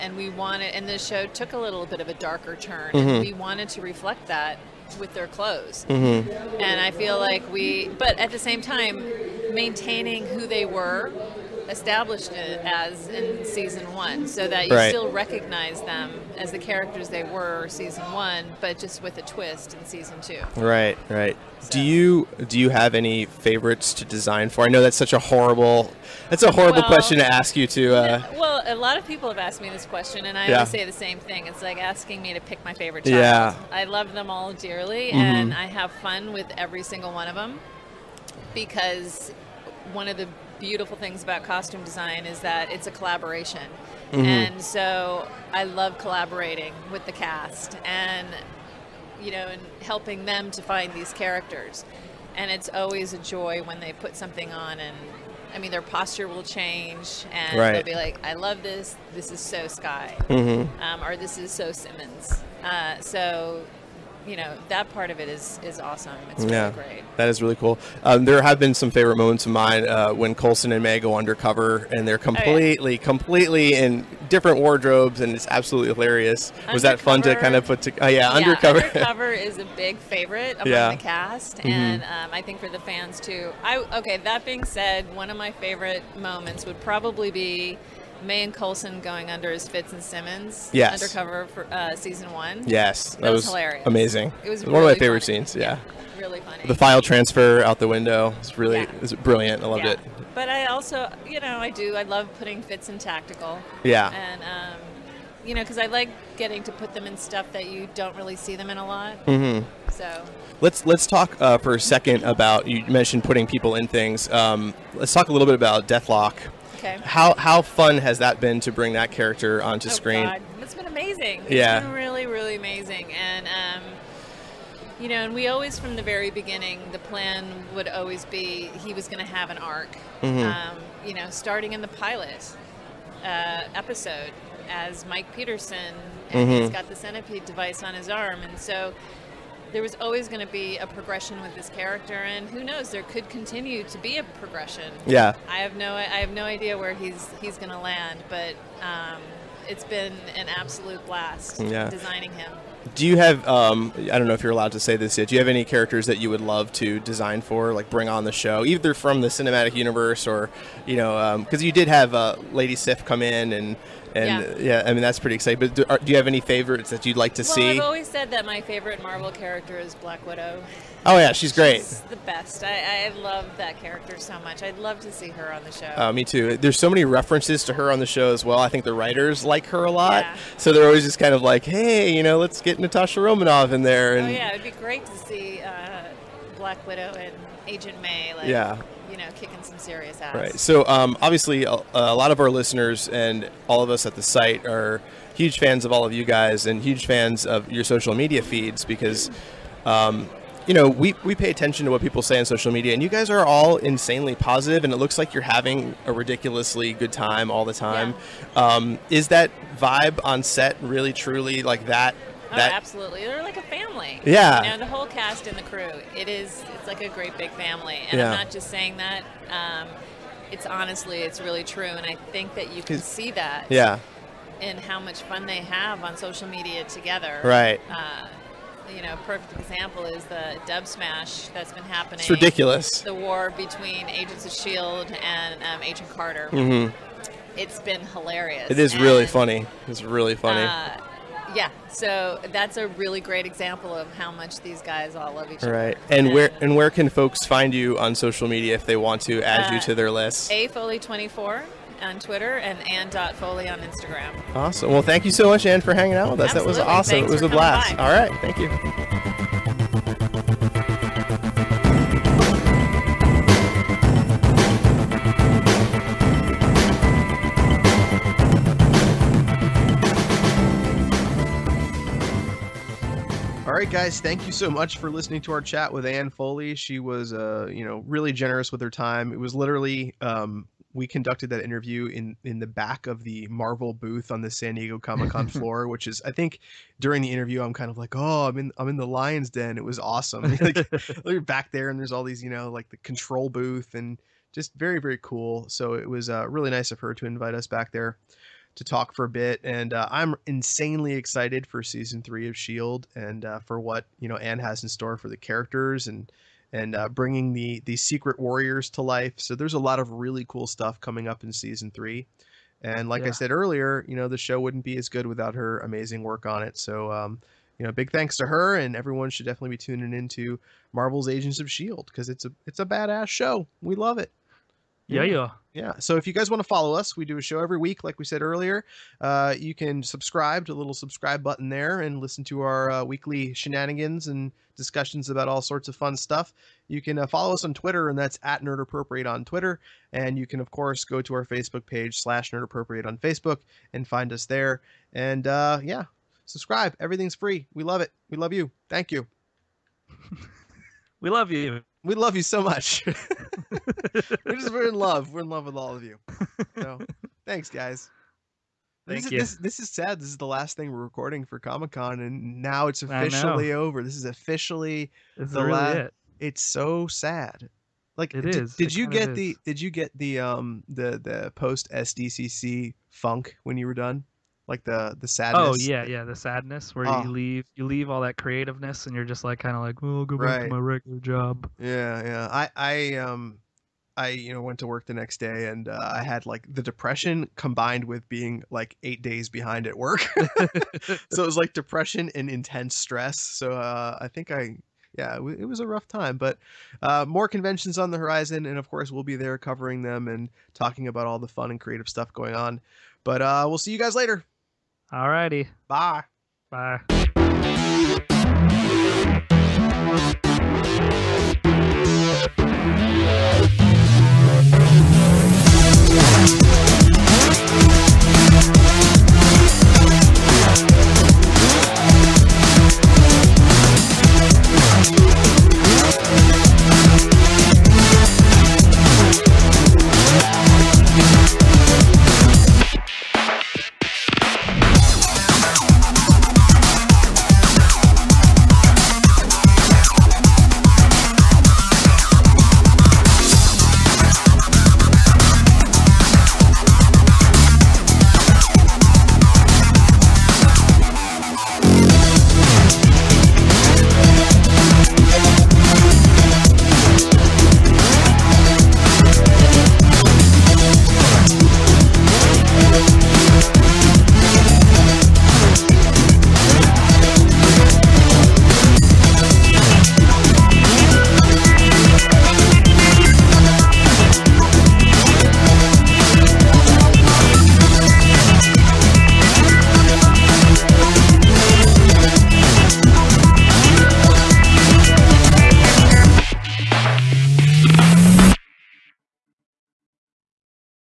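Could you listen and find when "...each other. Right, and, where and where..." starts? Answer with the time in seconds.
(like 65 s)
245 s.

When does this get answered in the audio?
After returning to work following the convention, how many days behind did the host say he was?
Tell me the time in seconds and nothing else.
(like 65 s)
389 s.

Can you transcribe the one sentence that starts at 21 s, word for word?
Do you do you have any favorites to design for?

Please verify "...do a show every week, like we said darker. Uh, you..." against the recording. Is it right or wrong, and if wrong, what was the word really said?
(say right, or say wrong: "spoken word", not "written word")
wrong: "earlier", not "darker".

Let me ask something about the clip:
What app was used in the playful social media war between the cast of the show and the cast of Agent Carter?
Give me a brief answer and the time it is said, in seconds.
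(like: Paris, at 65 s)
Dubsmash, at 230 s.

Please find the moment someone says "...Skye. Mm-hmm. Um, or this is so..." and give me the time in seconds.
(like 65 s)
59 s.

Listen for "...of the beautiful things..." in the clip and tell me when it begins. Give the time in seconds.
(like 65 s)
40 s.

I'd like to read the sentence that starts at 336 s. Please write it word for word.
You can uh, follow us on Twitter, and that's at Nerd Appropriate on Twitter.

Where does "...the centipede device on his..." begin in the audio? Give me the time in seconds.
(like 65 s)
136 s.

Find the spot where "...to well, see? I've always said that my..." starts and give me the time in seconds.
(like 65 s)
167 s.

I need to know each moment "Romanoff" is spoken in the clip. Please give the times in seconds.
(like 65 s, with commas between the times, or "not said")
183 s.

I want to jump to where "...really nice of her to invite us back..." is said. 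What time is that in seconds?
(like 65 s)
296 s.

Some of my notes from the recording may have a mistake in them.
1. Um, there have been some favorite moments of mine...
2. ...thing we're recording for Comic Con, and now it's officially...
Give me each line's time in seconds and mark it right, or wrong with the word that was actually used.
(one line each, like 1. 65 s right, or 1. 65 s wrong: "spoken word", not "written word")
1. 68 s right
2. 360 s right.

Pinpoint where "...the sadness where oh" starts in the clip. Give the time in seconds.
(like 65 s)
376 s.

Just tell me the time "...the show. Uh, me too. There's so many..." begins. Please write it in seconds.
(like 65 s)
175 s.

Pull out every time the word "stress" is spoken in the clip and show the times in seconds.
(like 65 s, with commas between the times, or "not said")
392 s.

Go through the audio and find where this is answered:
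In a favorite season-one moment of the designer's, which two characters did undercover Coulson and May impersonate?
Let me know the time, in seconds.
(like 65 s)
89 s.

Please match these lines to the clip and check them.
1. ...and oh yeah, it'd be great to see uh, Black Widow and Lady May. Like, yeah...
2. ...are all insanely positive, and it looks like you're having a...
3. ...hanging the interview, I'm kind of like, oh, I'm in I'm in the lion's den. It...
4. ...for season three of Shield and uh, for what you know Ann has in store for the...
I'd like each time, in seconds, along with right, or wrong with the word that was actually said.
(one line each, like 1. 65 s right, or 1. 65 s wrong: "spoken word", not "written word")
1. 184 s wrong: "Agent", not "Lady"
2. 203 s right
3. 286 s wrong: "during", not "hanging"
4. 301 s right.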